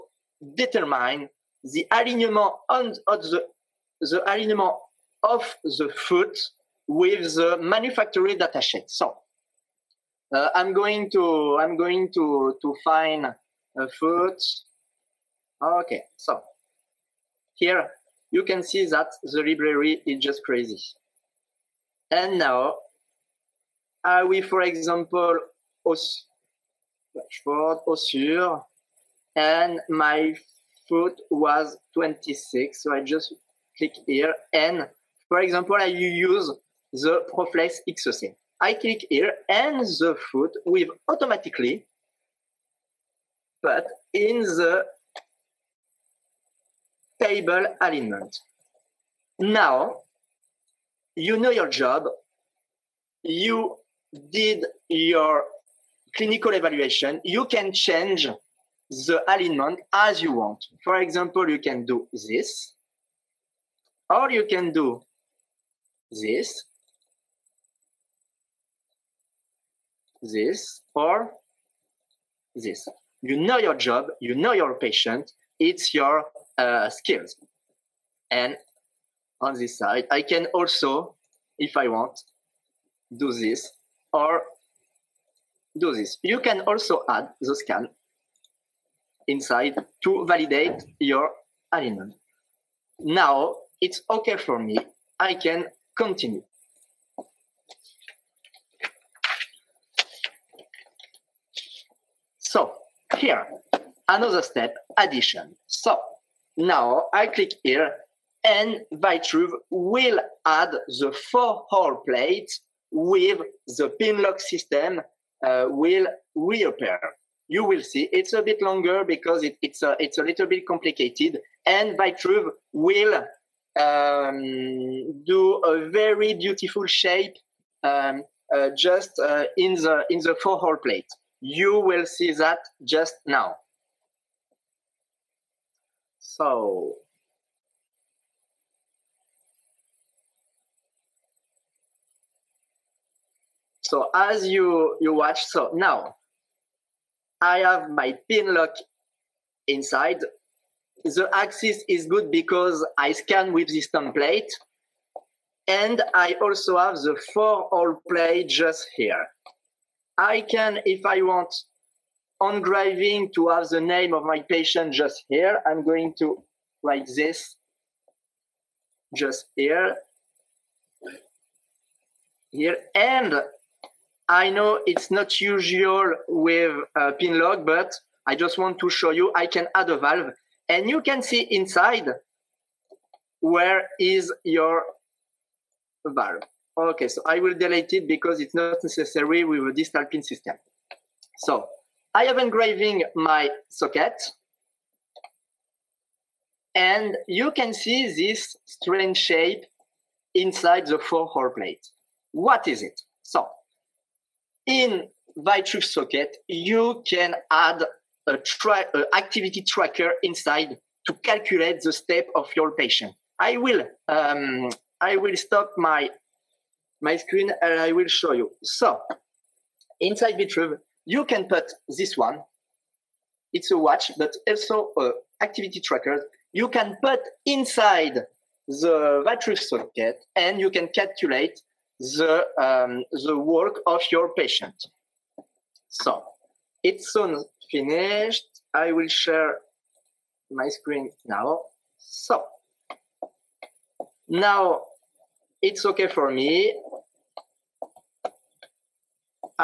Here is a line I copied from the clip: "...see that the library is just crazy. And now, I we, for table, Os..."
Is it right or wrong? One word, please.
wrong.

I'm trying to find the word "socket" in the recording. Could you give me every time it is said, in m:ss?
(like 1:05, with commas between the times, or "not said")
3:13, 3:25, 3:49.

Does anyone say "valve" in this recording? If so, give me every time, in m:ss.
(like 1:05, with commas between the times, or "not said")
2:59, 3:06.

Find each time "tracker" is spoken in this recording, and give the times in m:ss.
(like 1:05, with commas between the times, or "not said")
3:29, 3:45.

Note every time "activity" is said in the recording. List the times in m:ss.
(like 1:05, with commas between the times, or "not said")
3:29, 3:45.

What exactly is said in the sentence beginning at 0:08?
So uh, I'm going to I'm going to to find a foot.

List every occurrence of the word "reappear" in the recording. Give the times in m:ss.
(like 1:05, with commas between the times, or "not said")
1:56.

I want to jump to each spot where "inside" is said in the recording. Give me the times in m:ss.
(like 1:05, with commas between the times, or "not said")
1:29, 2:29, 3:01, 3:20, 3:30, 3:39, 3:47.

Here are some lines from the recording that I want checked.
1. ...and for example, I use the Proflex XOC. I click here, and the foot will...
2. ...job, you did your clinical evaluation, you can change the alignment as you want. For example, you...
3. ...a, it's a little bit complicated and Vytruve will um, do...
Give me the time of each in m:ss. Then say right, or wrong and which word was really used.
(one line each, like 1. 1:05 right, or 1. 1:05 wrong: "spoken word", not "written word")
1. 0:34 right
2. 0:51 right
3. 1:59 right.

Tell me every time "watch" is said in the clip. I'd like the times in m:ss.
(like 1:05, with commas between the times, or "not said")
2:25, 3:43.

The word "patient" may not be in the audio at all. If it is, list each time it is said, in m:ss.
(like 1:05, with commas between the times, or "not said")
1:14, 2:44, 3:32, 3:54.